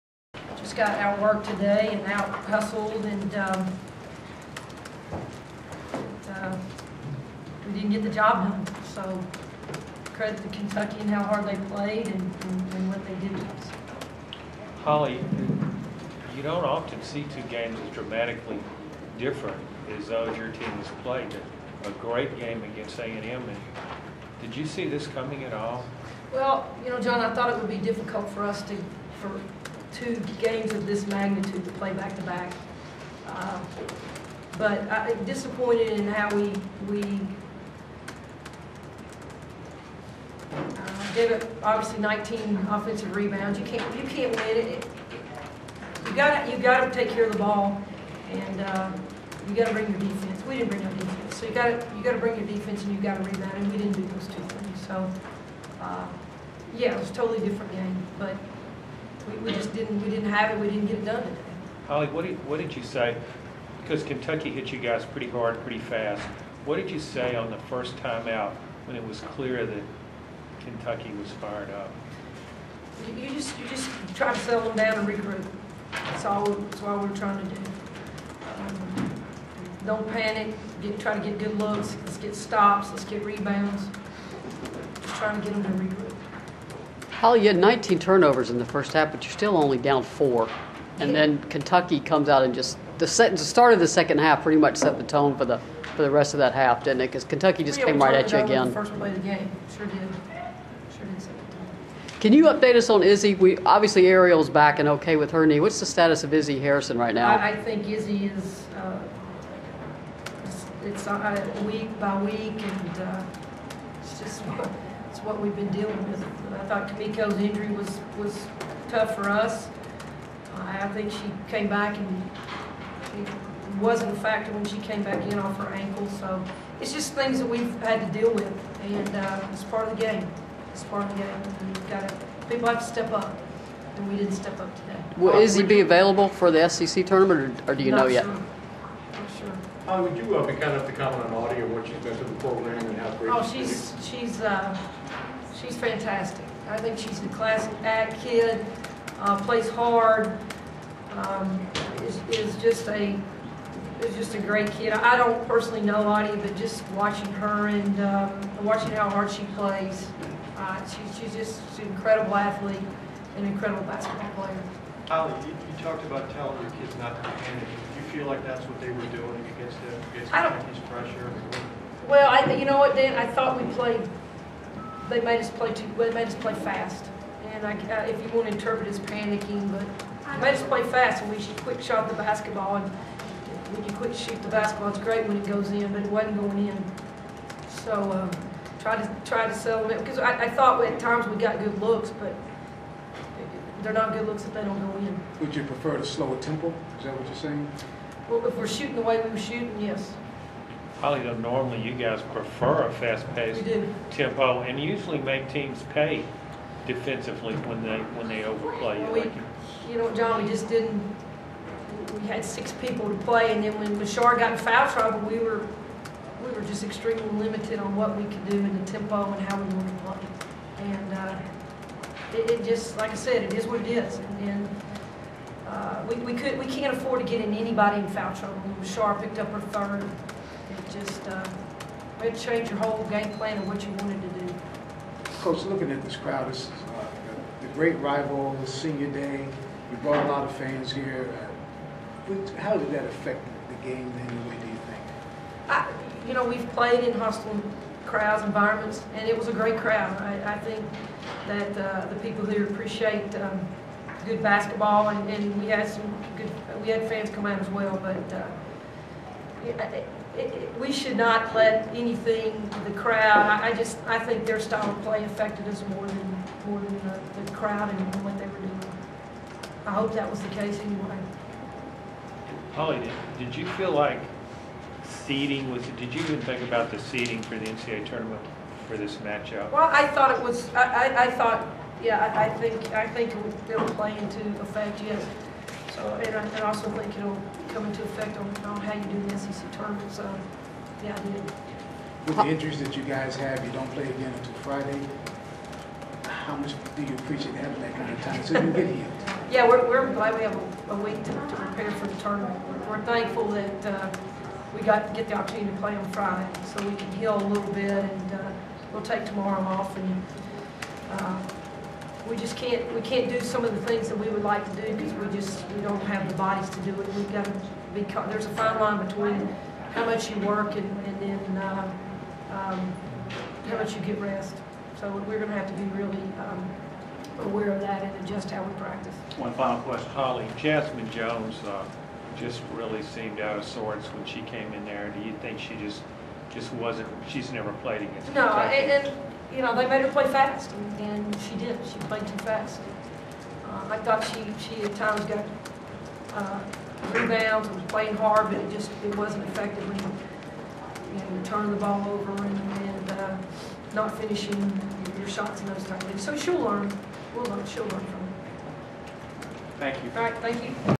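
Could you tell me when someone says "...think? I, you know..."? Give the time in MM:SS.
04:04.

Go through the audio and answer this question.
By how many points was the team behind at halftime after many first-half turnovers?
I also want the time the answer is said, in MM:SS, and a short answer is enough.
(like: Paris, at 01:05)
4, at 01:30.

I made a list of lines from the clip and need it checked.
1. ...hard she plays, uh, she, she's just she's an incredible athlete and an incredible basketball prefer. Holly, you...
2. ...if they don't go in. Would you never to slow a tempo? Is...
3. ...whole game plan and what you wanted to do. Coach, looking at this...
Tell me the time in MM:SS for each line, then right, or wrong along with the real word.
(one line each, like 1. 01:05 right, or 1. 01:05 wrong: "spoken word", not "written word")
1. 02:39 wrong: "player", not "prefer"
2. 03:14 wrong: "prefer", not "never"
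3. 03:52 right.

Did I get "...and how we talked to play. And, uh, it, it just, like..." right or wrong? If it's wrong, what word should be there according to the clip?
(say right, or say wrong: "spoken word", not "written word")
wrong: "wanted", not "talked".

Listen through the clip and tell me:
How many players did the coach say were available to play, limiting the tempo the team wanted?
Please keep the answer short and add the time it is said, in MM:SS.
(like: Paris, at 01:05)
6, at 03:32.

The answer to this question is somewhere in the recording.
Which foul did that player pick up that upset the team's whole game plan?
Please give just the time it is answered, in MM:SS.
03:49.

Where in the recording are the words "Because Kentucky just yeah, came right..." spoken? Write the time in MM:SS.
01:37.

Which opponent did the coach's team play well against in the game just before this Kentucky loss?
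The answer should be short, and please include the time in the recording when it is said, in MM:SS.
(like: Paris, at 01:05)
A&M, at 00:22.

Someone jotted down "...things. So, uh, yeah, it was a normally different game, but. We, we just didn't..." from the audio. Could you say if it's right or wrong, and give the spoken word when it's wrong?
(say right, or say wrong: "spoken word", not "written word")
wrong: "totally", not "normally".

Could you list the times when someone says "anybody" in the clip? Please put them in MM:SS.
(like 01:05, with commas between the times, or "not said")
03:47.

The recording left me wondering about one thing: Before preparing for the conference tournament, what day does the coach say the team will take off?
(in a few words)
Tomorrow.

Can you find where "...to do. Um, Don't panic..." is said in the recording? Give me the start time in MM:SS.
01:17.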